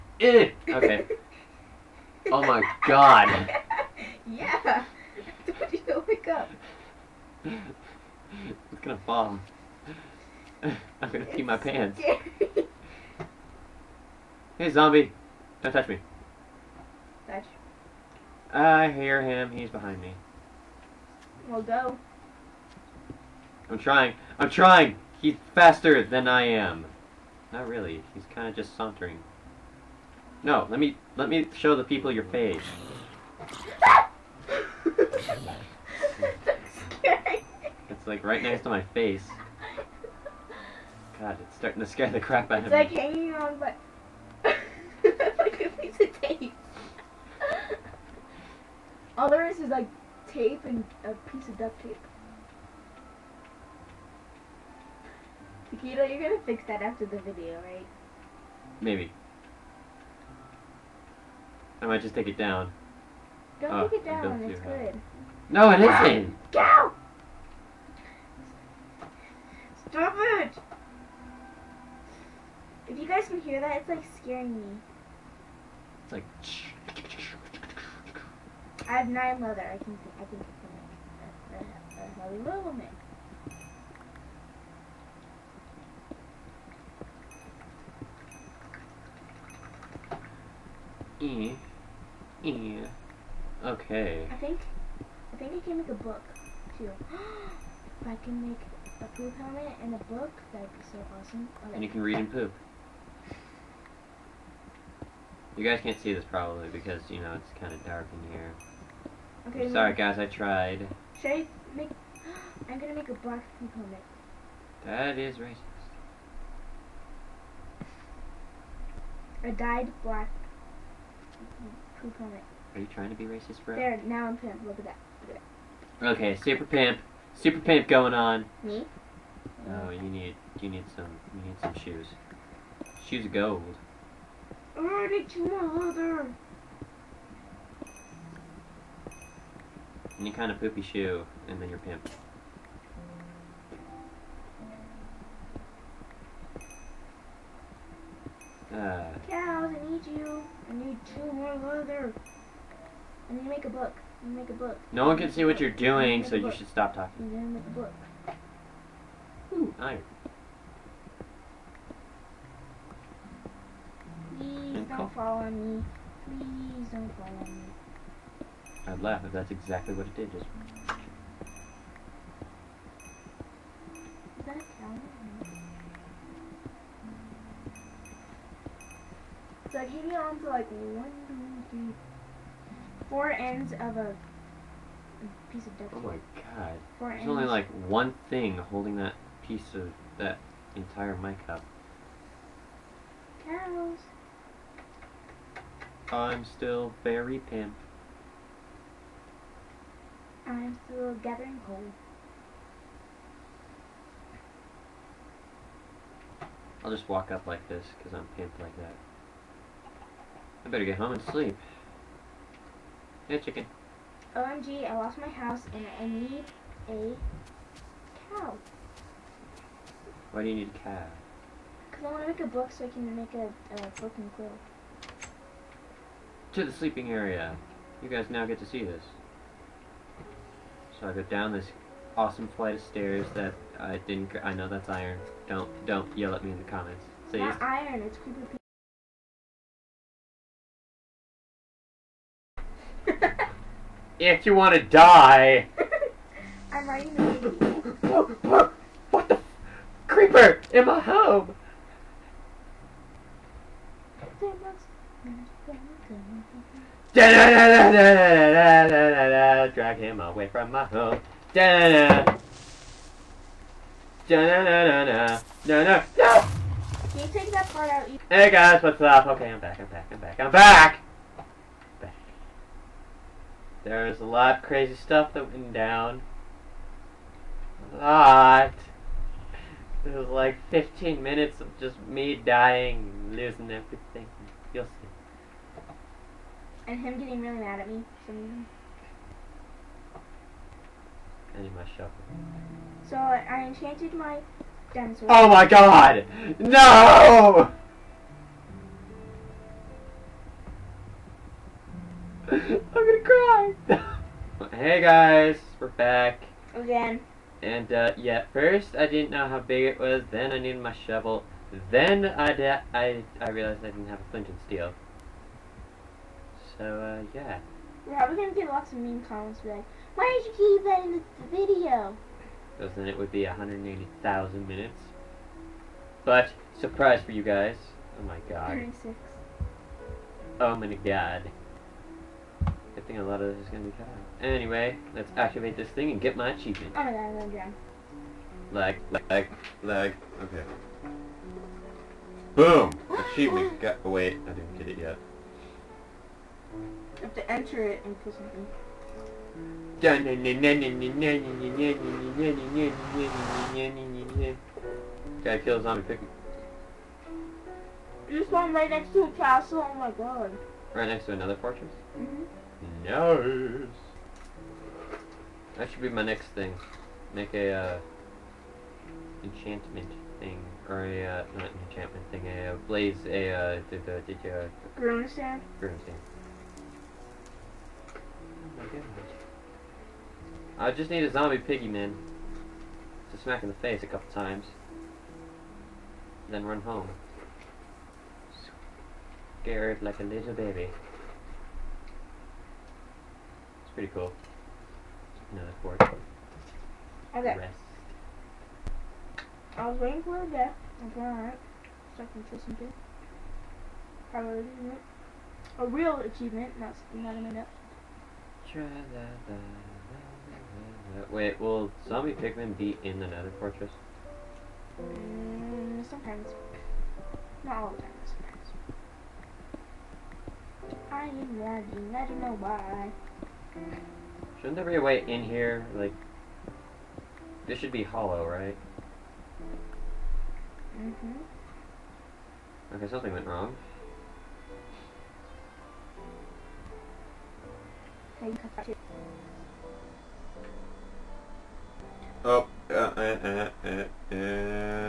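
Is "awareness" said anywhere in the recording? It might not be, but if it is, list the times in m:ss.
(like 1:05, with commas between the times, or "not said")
not said.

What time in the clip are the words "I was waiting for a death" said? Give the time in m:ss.
6:39.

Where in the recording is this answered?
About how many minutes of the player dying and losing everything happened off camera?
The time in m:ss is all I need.
4:40.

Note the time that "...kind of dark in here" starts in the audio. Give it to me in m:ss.
1:47.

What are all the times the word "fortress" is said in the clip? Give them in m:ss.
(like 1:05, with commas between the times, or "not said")
6:01, 6:53.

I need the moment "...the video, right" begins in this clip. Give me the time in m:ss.
0:57.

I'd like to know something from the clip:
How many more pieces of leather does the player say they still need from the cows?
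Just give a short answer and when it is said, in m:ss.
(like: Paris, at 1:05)
2, at 2:31.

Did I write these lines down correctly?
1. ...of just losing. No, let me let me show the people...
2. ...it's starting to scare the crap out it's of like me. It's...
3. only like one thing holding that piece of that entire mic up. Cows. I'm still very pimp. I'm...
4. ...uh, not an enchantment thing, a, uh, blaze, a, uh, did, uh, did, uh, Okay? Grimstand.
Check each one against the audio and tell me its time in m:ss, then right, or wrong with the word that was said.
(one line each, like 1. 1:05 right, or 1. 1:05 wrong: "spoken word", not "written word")
1. 0:28 wrong: "sauntering", not "losing"
2. 0:41 right
3. 3:07 right
4. 6:11 wrong: "Grimstand", not "Okay".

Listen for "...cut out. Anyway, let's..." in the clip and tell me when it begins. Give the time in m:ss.
5:33.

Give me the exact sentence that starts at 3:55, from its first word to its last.
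Don't don't yell at me in the comments.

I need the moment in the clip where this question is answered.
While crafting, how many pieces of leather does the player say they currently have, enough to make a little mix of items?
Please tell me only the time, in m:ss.
1:19.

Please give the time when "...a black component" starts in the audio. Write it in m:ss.
1:53.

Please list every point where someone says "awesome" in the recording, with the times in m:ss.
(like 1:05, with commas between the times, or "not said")
1:41, 3:52.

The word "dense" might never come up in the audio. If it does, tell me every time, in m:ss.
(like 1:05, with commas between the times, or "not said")
4:54.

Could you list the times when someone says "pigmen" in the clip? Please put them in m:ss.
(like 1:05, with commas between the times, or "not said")
6:52.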